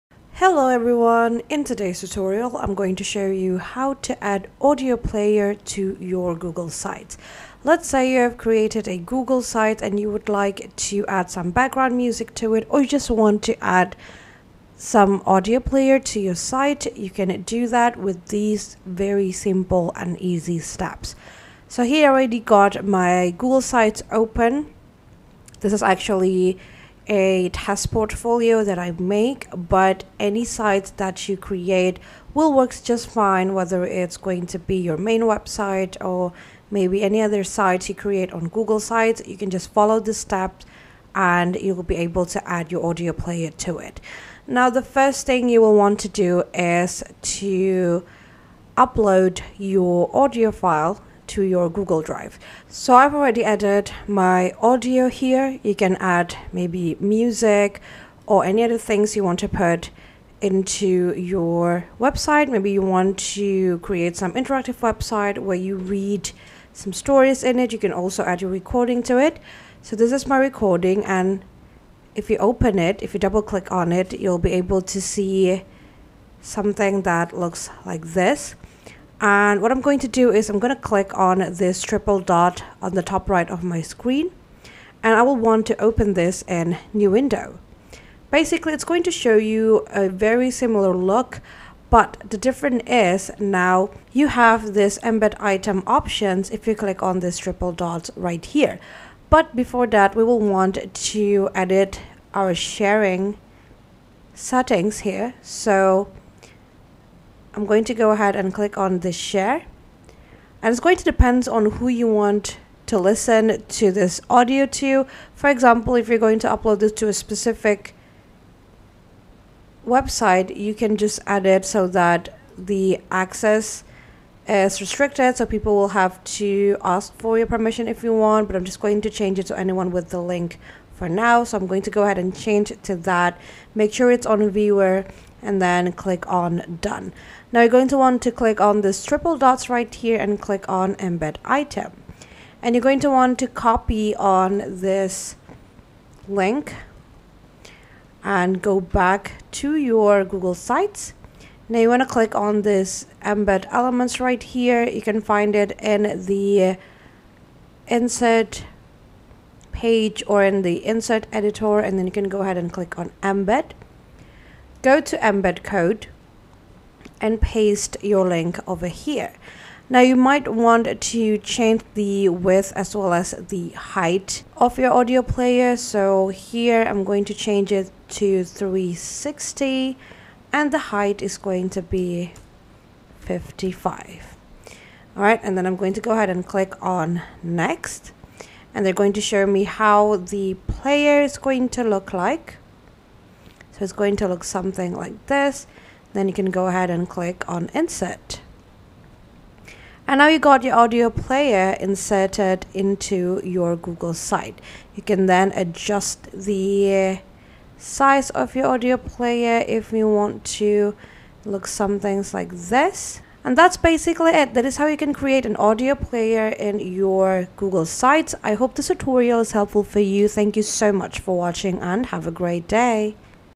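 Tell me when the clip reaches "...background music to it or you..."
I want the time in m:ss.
0:11.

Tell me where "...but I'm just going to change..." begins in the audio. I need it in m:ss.
2:08.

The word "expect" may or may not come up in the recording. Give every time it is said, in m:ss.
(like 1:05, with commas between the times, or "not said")
not said.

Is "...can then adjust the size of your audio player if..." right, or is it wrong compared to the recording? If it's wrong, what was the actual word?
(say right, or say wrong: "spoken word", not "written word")
right.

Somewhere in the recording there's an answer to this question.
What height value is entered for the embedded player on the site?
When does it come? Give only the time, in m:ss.
3:03.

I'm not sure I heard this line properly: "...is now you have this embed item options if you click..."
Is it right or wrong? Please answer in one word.
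right.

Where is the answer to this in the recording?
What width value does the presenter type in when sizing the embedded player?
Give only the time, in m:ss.
2:58.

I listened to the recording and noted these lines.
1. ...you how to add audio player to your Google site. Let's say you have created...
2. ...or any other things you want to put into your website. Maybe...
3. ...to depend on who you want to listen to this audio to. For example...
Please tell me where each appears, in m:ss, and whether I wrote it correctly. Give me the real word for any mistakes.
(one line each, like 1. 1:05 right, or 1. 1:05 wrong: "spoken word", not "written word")
1. 0:03 right
2. 0:58 right
3. 1:50 right.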